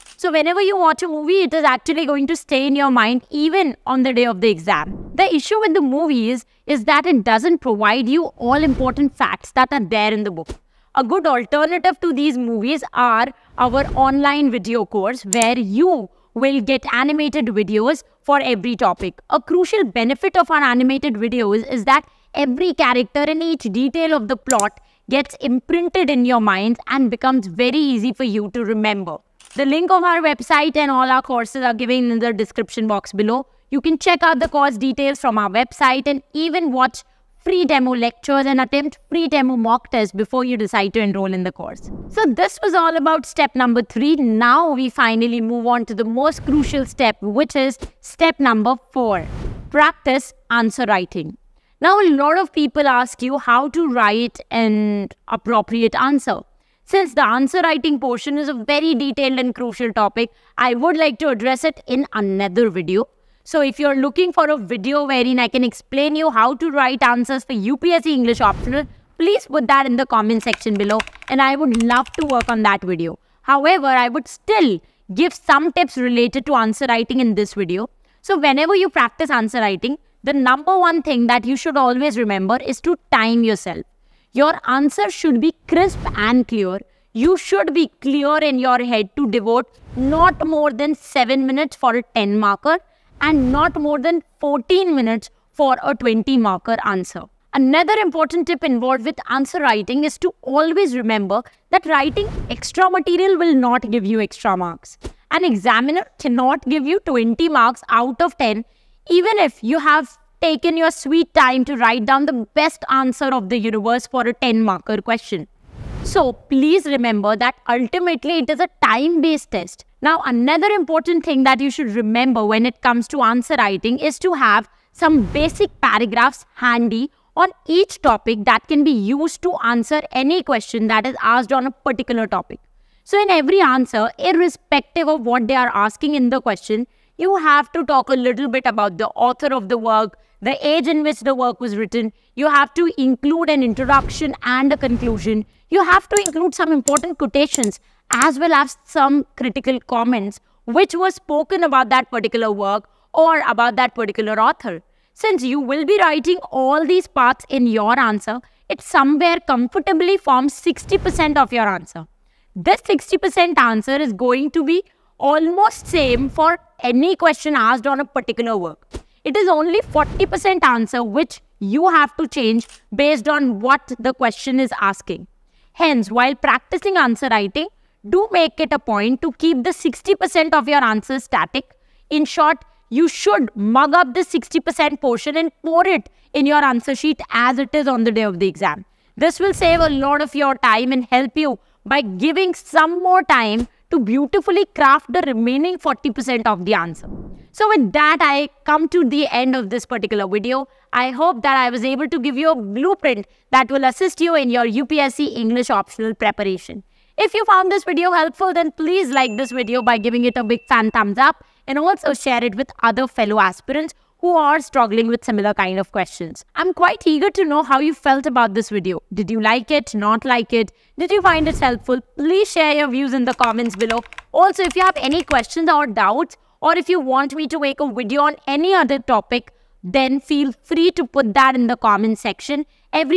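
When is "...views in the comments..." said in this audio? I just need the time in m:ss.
3:42.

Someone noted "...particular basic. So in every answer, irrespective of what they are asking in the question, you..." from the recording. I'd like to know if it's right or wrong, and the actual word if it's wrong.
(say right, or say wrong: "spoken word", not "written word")
wrong: "topic", not "basic".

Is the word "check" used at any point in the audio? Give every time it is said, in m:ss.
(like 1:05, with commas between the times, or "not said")
0:33.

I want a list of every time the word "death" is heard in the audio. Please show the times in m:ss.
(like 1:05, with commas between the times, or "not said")
not said.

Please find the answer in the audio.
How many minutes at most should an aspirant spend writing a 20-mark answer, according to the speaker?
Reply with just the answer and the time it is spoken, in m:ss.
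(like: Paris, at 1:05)
14 minutes, at 1:34.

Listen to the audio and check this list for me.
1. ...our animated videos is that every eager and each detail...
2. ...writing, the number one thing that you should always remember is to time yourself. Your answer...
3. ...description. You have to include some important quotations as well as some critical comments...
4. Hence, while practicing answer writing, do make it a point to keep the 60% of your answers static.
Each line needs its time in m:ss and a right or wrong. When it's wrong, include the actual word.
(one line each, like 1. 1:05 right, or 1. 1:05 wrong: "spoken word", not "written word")
1. 0:20 wrong: "character", not "eager"
2. 1:19 right
3. 2:24 wrong: "conclusion", not "description"
4. 2:55 right.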